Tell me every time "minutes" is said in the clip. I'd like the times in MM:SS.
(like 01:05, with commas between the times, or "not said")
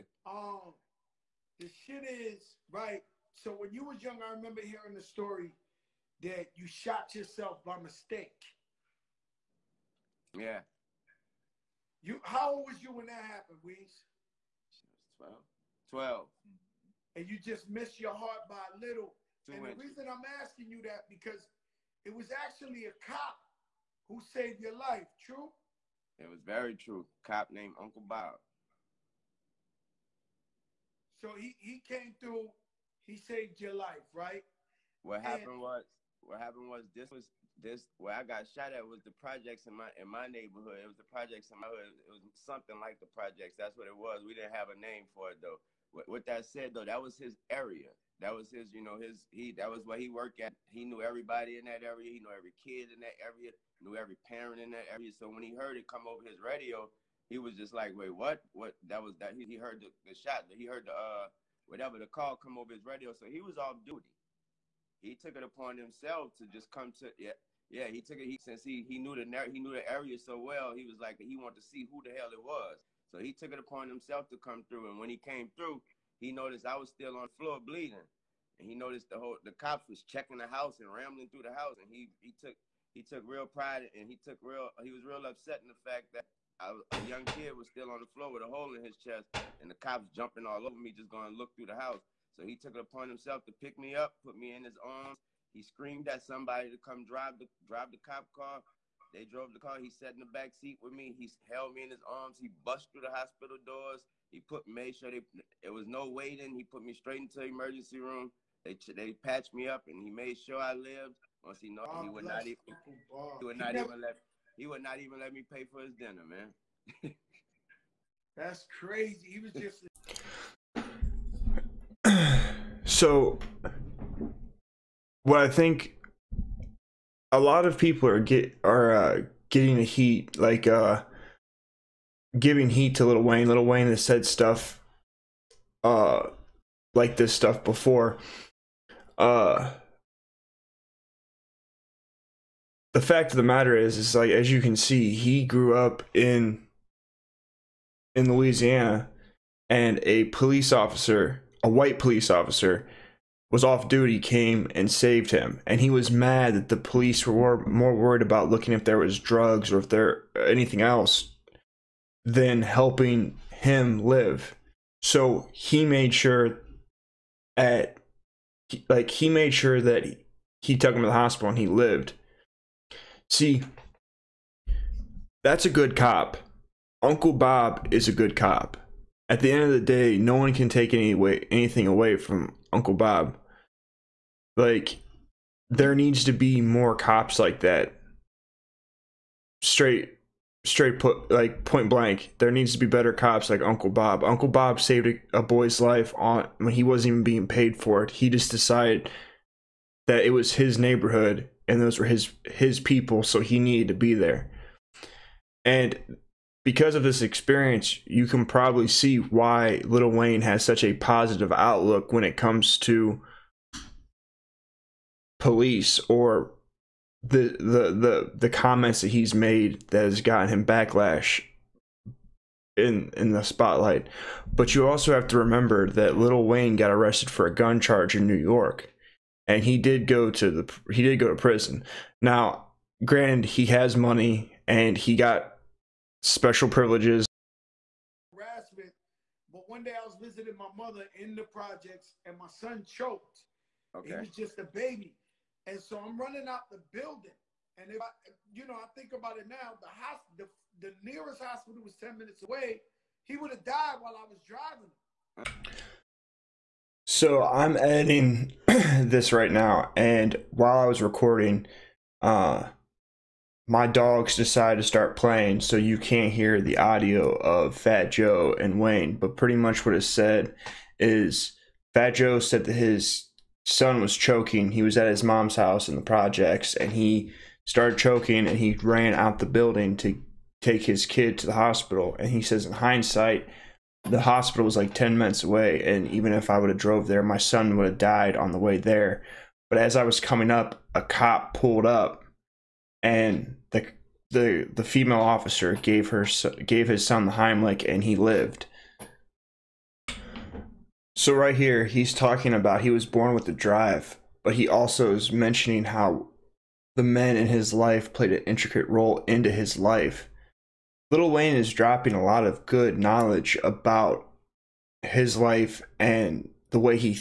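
04:12, 04:45.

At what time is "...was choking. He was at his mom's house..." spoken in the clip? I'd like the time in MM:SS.
04:33.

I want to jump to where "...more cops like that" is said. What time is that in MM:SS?
03:06.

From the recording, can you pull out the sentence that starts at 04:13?
He would have died while I was driving.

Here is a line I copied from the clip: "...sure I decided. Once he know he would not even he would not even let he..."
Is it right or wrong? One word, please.
wrong.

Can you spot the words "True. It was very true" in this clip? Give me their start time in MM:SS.
00:25.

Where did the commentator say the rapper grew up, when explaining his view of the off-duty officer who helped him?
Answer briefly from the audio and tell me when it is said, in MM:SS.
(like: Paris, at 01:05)
Louisiana, at 02:28.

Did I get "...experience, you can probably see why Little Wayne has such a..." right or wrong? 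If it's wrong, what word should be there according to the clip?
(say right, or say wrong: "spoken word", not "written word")
right.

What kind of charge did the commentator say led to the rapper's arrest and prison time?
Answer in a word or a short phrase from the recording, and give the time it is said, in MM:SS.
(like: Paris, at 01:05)
Gun charge, at 03:47.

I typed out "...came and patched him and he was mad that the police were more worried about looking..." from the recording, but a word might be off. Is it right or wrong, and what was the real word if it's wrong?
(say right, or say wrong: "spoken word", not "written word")
wrong: "saved", not "patched".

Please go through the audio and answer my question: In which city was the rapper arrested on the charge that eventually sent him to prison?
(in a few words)
New York.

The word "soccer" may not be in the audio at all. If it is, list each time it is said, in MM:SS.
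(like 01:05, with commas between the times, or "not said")
not said.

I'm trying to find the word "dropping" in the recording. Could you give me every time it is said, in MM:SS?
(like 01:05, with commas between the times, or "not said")
05:11.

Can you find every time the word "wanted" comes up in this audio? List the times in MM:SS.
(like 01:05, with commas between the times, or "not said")
01:11.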